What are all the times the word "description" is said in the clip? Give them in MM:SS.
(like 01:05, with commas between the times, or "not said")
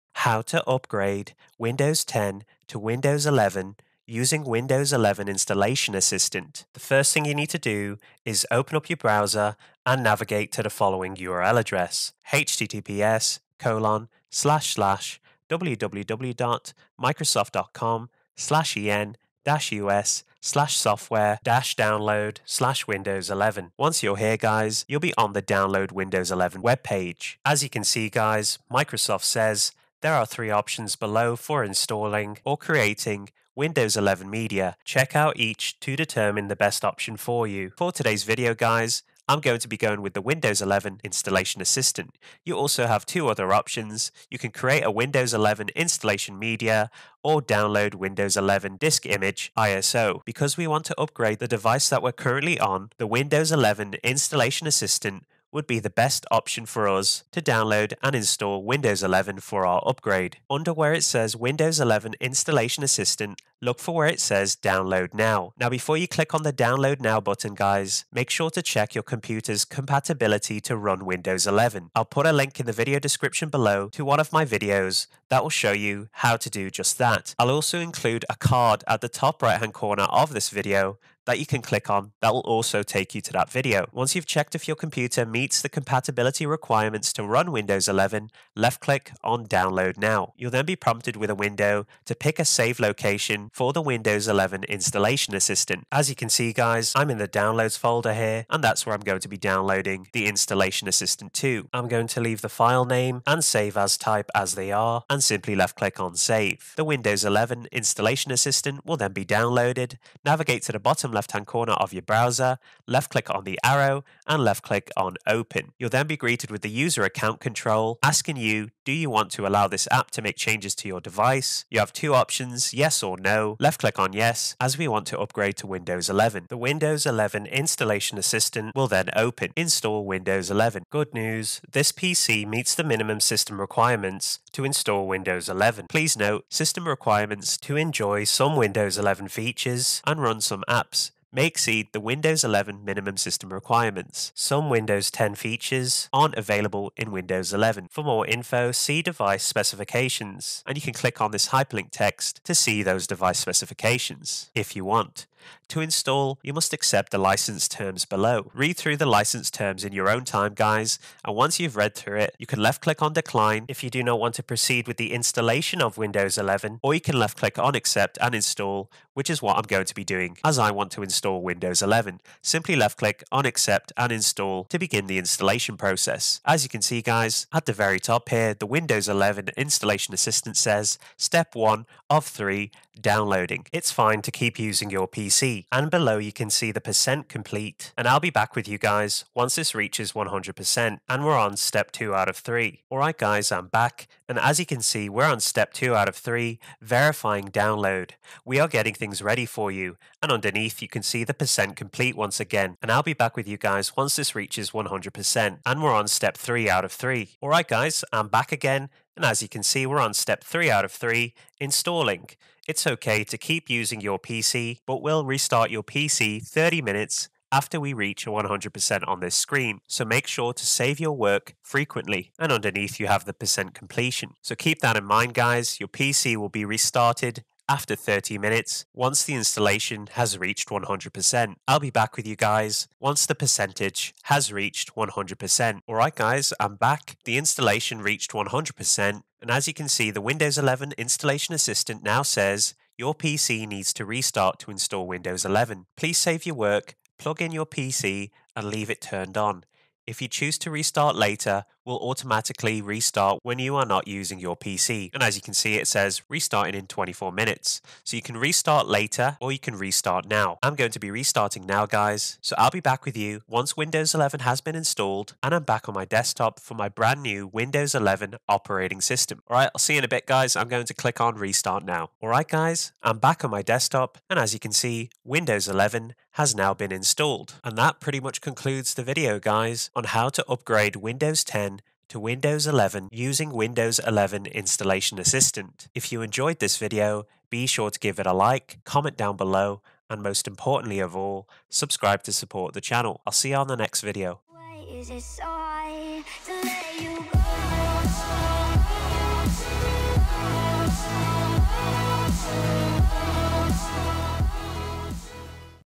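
01:12.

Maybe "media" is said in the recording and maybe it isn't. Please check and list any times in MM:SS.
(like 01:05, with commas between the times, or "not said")
00:34, 00:46.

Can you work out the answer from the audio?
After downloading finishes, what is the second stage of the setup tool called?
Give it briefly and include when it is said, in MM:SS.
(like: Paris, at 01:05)
Verifying download, at 03:16.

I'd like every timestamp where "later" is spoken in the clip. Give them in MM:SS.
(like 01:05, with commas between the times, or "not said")
04:11, 04:18.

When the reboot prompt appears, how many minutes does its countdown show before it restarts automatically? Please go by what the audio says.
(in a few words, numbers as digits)
24.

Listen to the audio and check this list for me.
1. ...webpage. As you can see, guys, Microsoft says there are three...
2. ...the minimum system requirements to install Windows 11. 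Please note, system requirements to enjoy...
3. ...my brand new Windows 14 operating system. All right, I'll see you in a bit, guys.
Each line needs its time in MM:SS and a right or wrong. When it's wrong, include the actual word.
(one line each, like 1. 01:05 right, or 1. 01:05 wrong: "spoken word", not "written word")
1. 00:26 right
2. 02:12 right
3. 04:26 wrong: "11", not "14".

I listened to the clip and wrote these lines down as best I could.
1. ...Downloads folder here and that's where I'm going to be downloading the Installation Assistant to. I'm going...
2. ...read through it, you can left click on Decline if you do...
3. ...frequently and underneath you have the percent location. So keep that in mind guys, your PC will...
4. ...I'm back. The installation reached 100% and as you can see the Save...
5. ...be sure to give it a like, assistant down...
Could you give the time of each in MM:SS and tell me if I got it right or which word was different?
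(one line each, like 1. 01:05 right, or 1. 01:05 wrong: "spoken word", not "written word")
1. 01:37 right
2. 02:41 right
3. 03:41 wrong: "completion", not "location"
4. 03:56 wrong: "Windows", not "Save"
5. 04:47 wrong: "comment", not "assistant".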